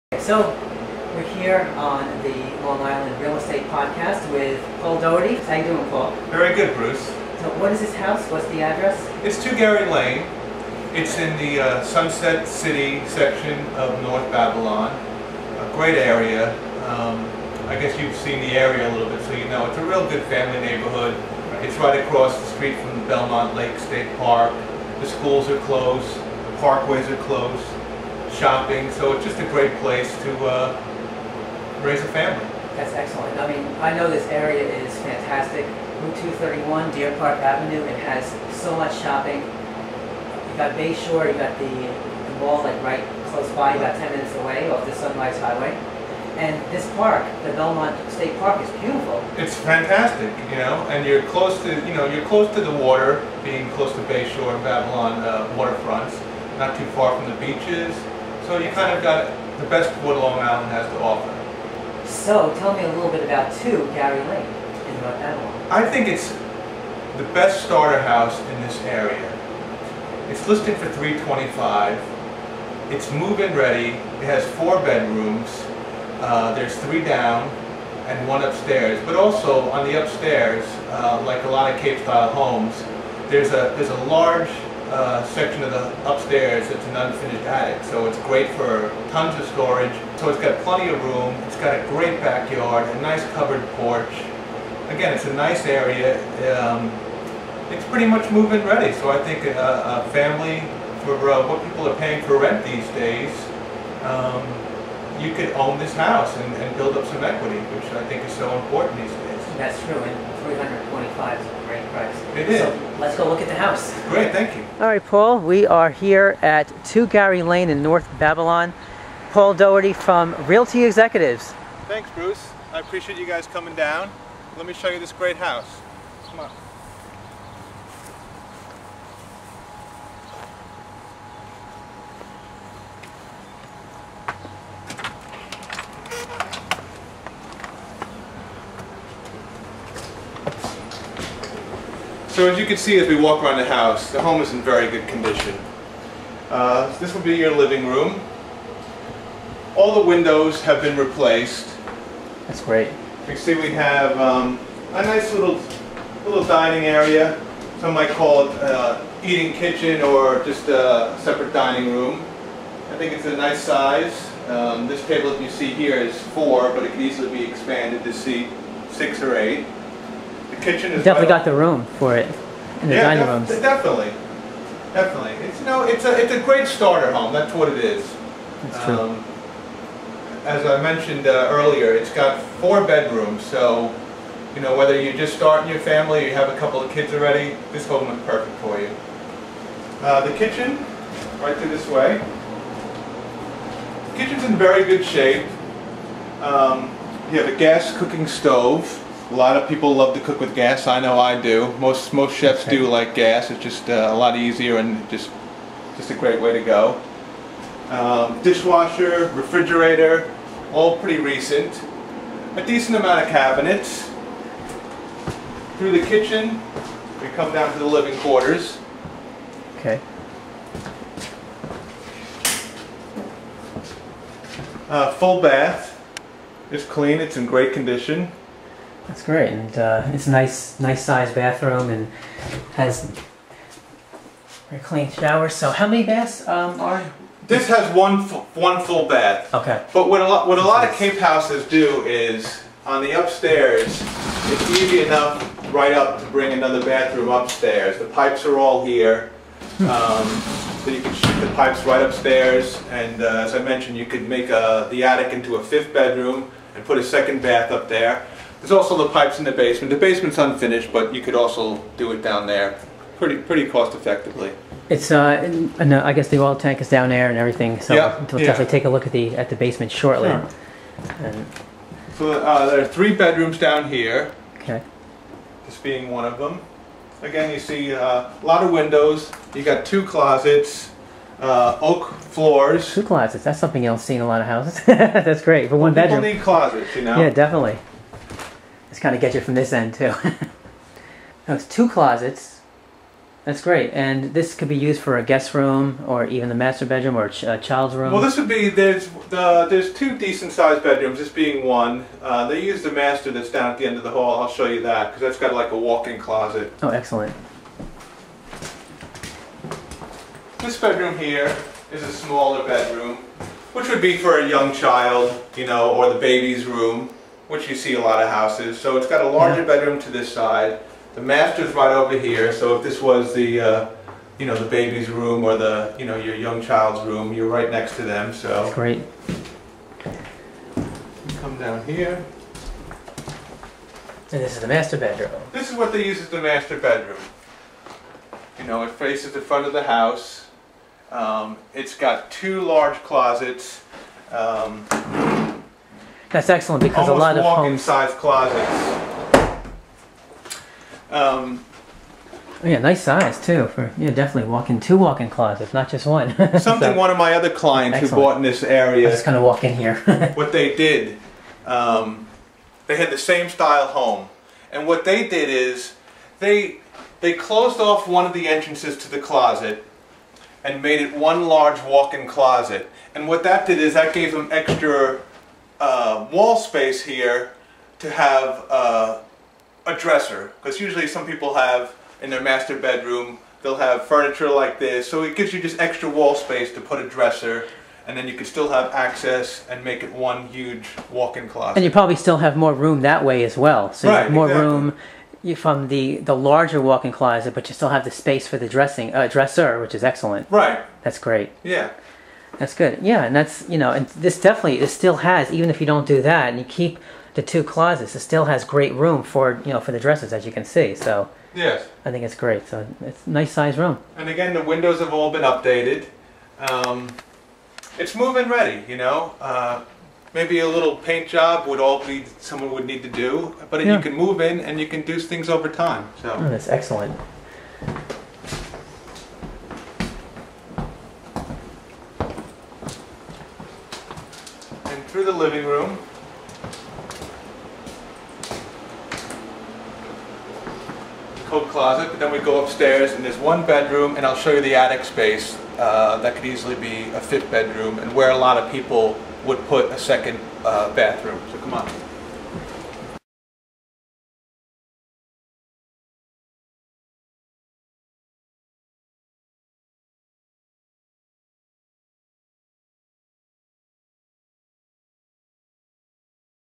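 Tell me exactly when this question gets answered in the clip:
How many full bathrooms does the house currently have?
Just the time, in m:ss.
3:57.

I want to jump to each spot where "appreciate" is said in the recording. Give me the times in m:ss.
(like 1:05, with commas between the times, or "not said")
2:02.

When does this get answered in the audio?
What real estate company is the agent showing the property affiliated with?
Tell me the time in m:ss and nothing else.
2:00.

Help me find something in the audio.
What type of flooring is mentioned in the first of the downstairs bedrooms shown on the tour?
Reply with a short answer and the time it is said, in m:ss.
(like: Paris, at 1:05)
oak, at 4:41.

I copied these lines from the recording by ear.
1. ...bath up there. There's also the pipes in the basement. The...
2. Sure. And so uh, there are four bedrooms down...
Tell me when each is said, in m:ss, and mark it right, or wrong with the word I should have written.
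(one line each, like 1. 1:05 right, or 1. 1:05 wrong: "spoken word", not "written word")
1. 4:17 right
2. 4:30 wrong: "three", not "four".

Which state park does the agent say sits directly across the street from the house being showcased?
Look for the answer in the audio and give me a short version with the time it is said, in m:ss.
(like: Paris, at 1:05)
Belmont Lake State Park, at 0:23.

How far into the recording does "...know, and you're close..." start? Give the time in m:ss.
0:50.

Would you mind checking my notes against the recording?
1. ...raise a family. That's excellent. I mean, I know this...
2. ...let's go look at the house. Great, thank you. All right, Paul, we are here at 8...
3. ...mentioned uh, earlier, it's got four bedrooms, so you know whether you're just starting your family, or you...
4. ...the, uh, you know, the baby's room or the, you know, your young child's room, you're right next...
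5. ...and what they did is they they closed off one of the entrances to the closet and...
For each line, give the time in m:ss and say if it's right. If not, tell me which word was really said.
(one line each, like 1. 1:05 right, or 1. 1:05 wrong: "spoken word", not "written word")
1. 0:31 right
2. 1:52 wrong: "2", not "8"
3. 3:00 right
4. 5:23 right
5. 6:04 right.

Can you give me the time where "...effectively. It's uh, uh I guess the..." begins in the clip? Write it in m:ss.
4:23.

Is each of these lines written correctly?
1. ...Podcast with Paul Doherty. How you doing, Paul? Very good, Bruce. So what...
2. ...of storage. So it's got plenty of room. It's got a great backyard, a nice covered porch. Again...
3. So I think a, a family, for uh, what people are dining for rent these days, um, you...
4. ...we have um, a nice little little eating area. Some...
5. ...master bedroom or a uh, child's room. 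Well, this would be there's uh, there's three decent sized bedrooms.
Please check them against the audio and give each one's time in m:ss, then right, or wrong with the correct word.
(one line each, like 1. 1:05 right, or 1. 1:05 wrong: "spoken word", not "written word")
1. 0:03 right
2. 1:29 right
3. 1:38 wrong: "paying", not "dining"
4. 2:33 wrong: "dining", not "eating"
5. 4:56 wrong: "two", not "three".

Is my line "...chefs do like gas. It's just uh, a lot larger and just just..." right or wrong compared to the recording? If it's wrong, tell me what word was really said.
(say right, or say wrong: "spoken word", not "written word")
wrong: "easier", not "larger".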